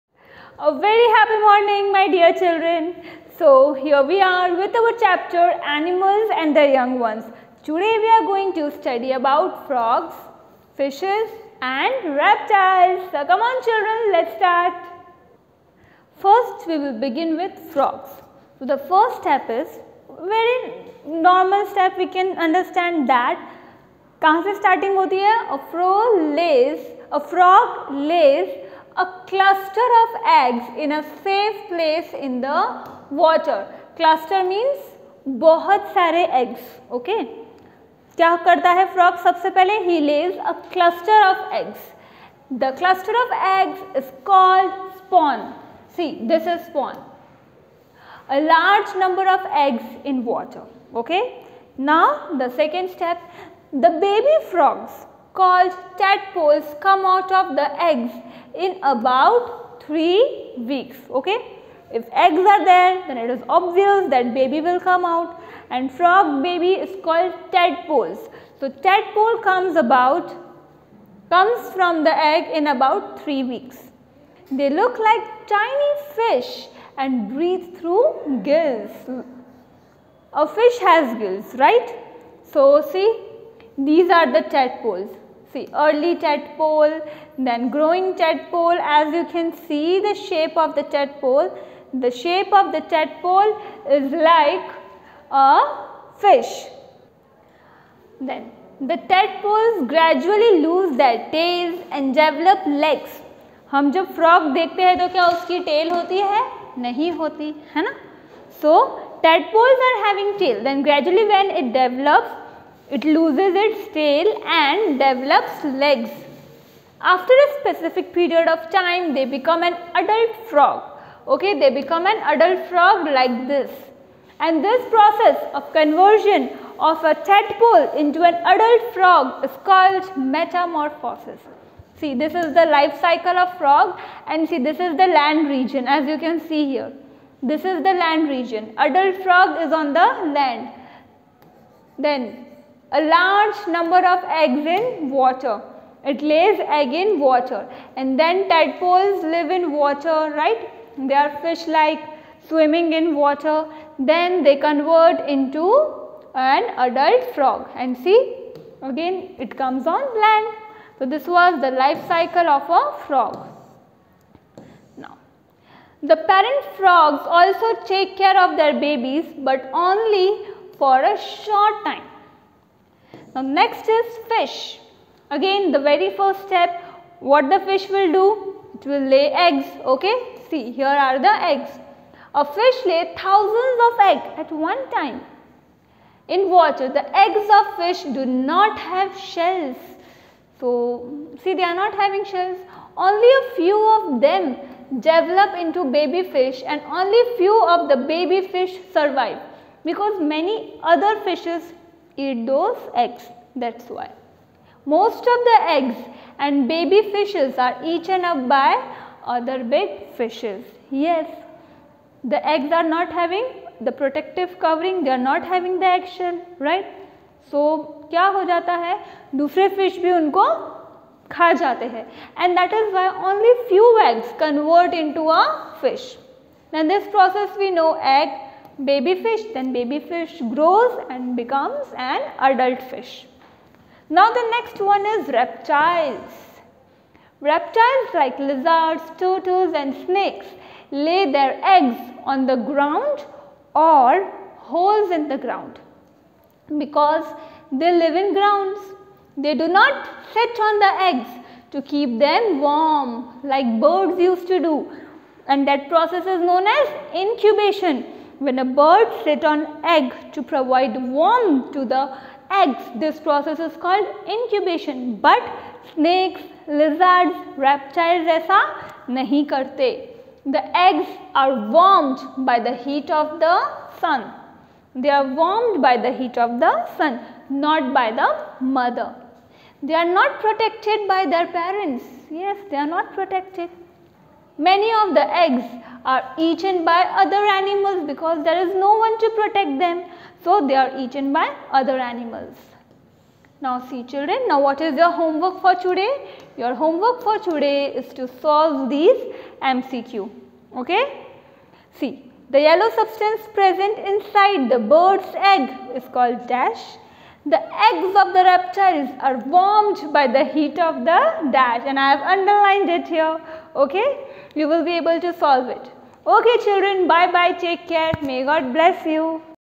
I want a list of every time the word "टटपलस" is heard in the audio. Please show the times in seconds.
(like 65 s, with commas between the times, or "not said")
109 s.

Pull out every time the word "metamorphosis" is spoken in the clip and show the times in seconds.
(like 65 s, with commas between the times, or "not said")
130 s.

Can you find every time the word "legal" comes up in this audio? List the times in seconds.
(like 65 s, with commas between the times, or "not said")
not said.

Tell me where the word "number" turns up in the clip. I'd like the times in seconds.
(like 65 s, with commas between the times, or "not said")
49 s, 143 s.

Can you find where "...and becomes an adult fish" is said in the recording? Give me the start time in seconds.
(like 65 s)
231 s.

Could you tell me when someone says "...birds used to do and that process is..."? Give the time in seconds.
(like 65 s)
253 s.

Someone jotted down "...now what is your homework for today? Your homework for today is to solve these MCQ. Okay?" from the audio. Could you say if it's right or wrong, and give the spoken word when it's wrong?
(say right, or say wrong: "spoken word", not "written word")
right.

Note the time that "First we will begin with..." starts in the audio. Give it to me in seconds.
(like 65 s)
16 s.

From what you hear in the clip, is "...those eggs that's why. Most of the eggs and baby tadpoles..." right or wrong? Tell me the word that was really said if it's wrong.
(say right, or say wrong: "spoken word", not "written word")
wrong: "fishes", not "tadpoles".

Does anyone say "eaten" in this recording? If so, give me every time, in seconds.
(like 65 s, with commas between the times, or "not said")
207 s, 286 s, 290 s.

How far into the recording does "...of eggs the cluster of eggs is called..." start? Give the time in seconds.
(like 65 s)
41 s.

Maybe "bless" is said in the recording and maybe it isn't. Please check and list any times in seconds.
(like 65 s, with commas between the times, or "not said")
318 s.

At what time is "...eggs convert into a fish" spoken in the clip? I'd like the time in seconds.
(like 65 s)
224 s.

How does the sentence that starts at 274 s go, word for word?
They are warmed by the heat of the sun, not by the mother.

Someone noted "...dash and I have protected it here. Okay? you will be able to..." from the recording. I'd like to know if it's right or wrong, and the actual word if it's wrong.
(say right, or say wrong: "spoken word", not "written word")
wrong: "underlined", not "protected".